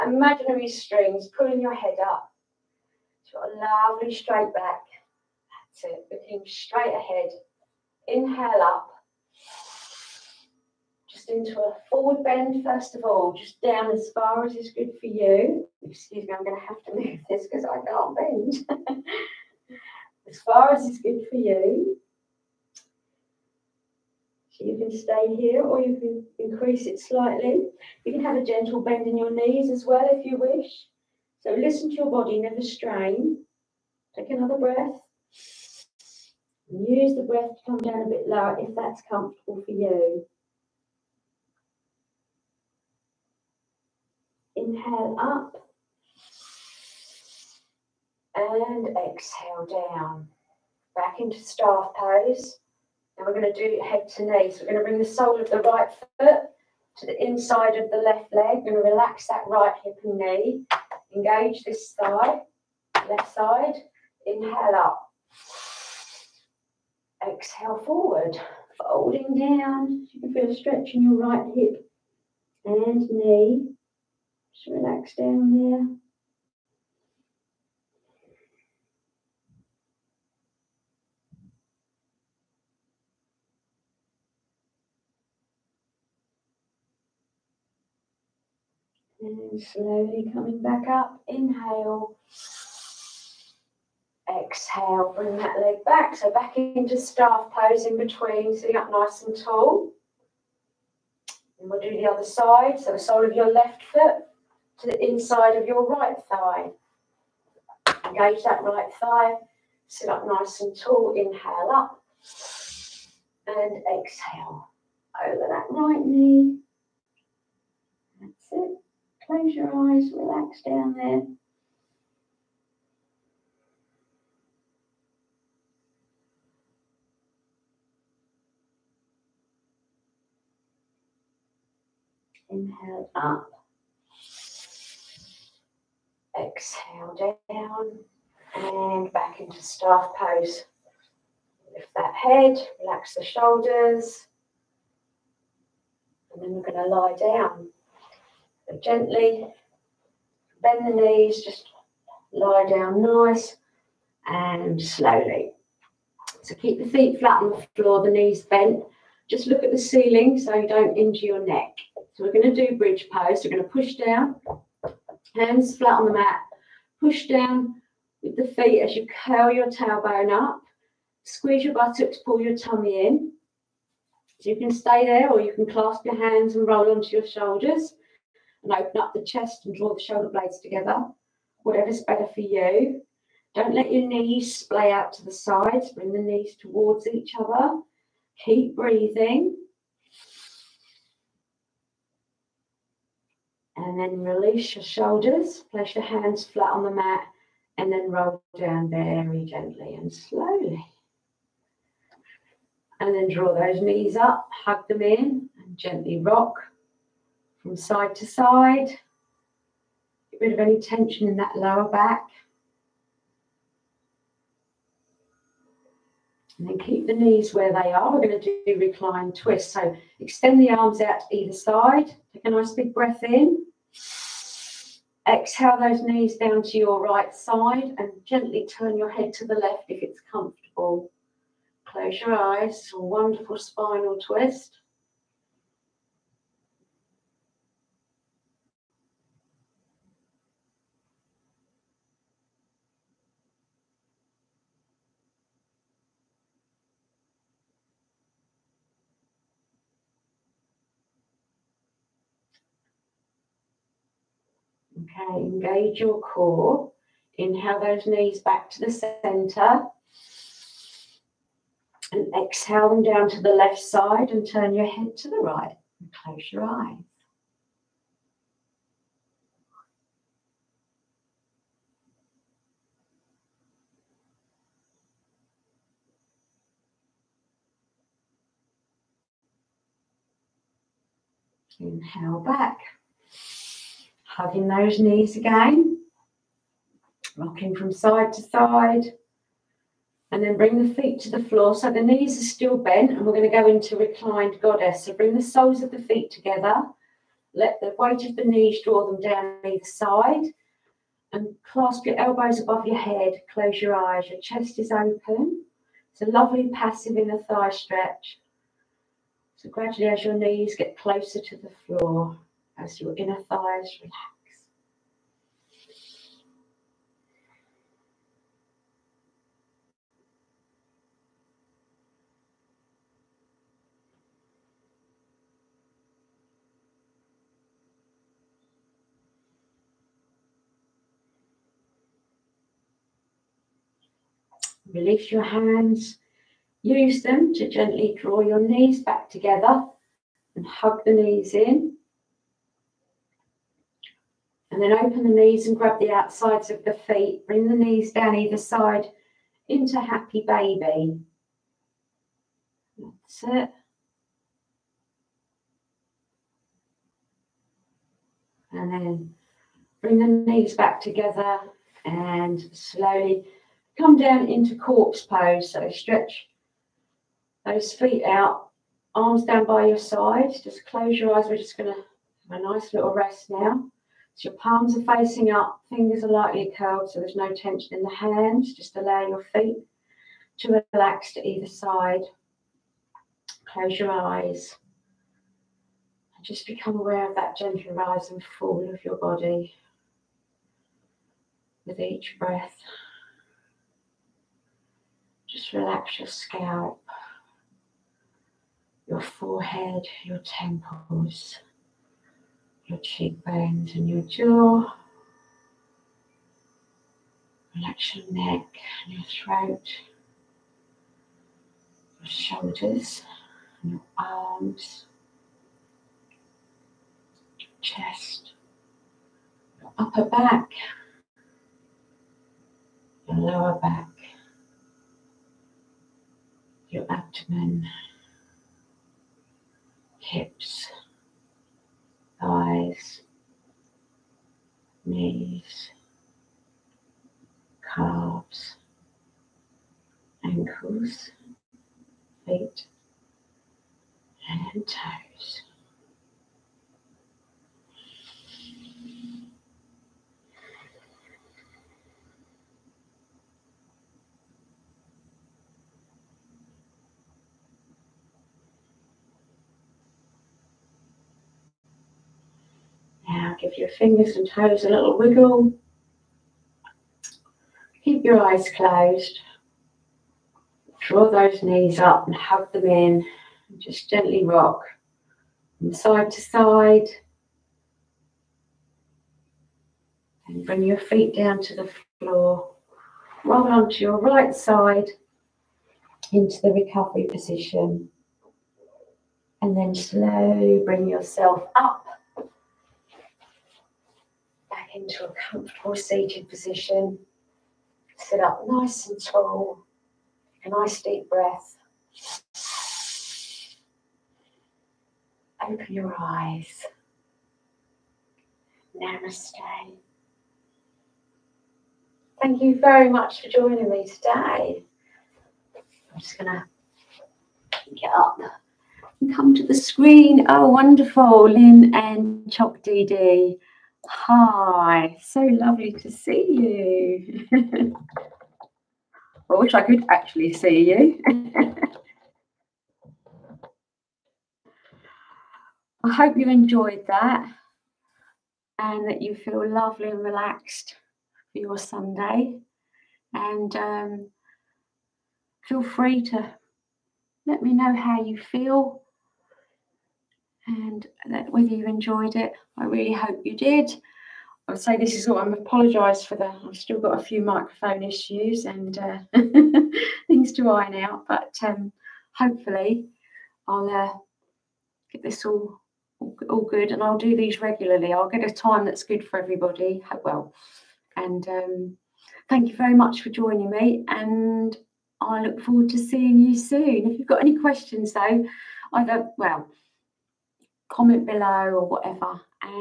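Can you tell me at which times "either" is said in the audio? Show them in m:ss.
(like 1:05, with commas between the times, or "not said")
3:41, 4:59, 5:48, 6:21, 9:38.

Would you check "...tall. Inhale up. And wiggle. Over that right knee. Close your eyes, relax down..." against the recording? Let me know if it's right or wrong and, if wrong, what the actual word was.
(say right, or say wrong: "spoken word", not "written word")
wrong: "exhale", not "wiggle".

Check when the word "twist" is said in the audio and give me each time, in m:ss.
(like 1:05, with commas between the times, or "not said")
3:39, 3:54.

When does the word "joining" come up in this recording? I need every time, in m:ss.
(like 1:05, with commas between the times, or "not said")
8:33, 9:33.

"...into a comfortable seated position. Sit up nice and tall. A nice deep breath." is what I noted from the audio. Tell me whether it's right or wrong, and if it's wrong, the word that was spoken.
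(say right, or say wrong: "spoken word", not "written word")
right.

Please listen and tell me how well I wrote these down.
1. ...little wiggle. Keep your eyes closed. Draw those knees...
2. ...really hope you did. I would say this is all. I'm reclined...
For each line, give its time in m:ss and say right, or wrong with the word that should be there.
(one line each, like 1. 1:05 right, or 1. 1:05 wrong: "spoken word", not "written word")
1. 7:44 right
2. 9:12 wrong: "apologised", not "reclined".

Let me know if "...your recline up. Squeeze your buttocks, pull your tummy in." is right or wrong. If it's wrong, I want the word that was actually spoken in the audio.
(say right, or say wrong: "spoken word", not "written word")
wrong: "tailbone", not "recline".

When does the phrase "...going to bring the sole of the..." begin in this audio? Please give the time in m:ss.
0:54.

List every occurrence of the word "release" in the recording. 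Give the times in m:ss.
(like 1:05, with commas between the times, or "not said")
3:14, 5:34.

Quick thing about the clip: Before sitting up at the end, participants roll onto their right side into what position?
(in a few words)
Recovery position.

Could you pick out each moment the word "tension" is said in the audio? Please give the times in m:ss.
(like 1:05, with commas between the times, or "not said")
3:30, 6:17.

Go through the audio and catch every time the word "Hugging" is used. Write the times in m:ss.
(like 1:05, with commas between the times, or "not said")
4:44.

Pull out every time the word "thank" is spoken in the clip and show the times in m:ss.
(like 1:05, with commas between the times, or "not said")
8:32, 9:32.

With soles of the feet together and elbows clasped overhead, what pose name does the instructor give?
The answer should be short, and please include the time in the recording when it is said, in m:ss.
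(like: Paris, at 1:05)
Reclined goddess, at 4:53.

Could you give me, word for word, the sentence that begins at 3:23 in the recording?
And then draw those knees up, hug them in, and gently rock from side to side.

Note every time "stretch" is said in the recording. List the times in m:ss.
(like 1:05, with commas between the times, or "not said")
1:10, 5:07, 6:05.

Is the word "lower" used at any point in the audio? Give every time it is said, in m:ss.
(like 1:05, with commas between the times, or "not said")
0:38, 3:31, 7:03.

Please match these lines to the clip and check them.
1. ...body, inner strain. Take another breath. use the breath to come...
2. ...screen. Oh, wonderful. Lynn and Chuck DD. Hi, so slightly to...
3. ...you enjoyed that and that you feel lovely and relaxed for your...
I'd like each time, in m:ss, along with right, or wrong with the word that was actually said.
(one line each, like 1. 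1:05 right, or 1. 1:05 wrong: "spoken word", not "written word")
1. 0:32 wrong: "never", not "inner"
2. 8:39 wrong: "lovely", not "slightly"
3. 8:56 right.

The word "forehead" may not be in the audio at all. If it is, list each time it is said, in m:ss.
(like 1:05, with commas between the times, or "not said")
6:39.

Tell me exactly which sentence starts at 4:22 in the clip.
And exhale them down to the left side and turn your head to the right and close your eyes.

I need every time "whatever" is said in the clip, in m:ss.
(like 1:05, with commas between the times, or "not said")
3:01, 9:41.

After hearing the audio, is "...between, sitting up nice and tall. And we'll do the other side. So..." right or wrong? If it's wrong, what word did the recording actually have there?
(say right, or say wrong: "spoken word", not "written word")
right.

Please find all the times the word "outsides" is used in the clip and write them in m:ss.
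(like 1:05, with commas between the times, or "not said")
5:46.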